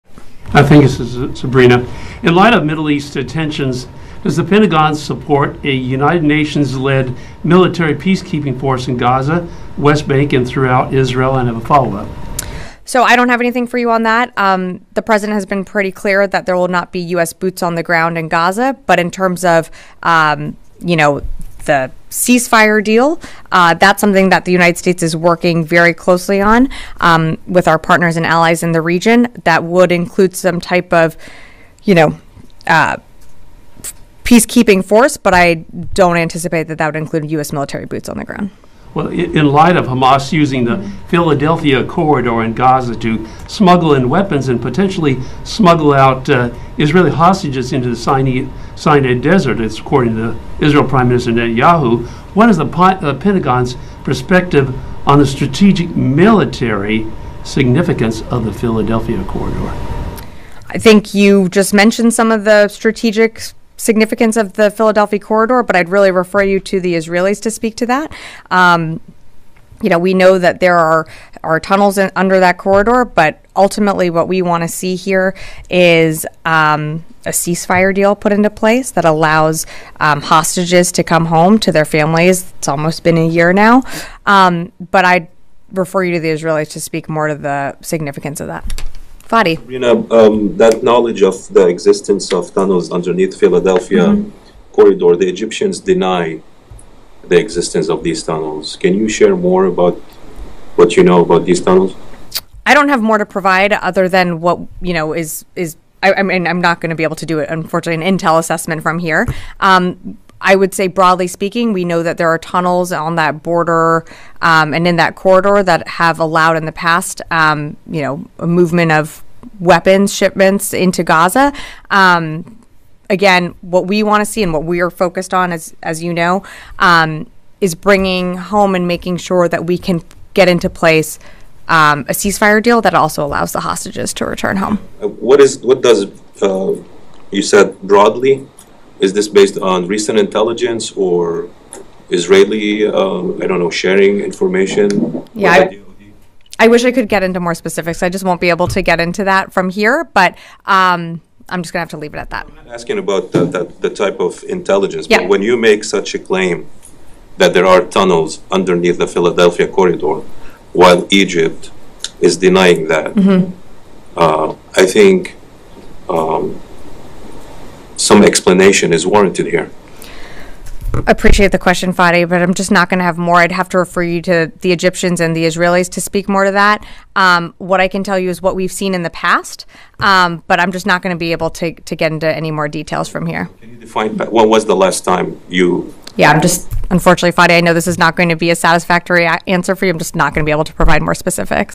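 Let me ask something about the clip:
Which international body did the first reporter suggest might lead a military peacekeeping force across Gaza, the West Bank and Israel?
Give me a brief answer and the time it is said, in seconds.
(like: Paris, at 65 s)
United Nations, at 5 s.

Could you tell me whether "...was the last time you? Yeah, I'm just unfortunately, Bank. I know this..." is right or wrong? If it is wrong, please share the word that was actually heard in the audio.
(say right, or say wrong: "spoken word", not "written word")
wrong: "Fadi", not "Bank".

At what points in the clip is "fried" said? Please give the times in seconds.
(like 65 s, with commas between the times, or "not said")
not said.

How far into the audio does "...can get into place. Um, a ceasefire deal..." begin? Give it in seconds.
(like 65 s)
129 s.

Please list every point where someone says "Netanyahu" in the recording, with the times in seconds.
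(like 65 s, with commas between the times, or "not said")
51 s.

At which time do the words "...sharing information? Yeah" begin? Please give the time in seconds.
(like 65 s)
143 s.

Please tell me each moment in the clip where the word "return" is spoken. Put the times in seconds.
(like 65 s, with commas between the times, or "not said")
134 s.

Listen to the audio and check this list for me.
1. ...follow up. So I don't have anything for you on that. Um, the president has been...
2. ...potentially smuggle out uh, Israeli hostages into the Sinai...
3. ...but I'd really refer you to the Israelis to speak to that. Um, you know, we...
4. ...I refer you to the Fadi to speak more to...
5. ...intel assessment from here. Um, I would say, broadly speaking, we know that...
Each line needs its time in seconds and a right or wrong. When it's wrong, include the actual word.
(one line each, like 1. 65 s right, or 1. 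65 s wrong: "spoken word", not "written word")
1. 11 s right
2. 44 s right
3. 65 s right
4. 85 s wrong: "Israelis", not "Fadi"
5. 108 s right.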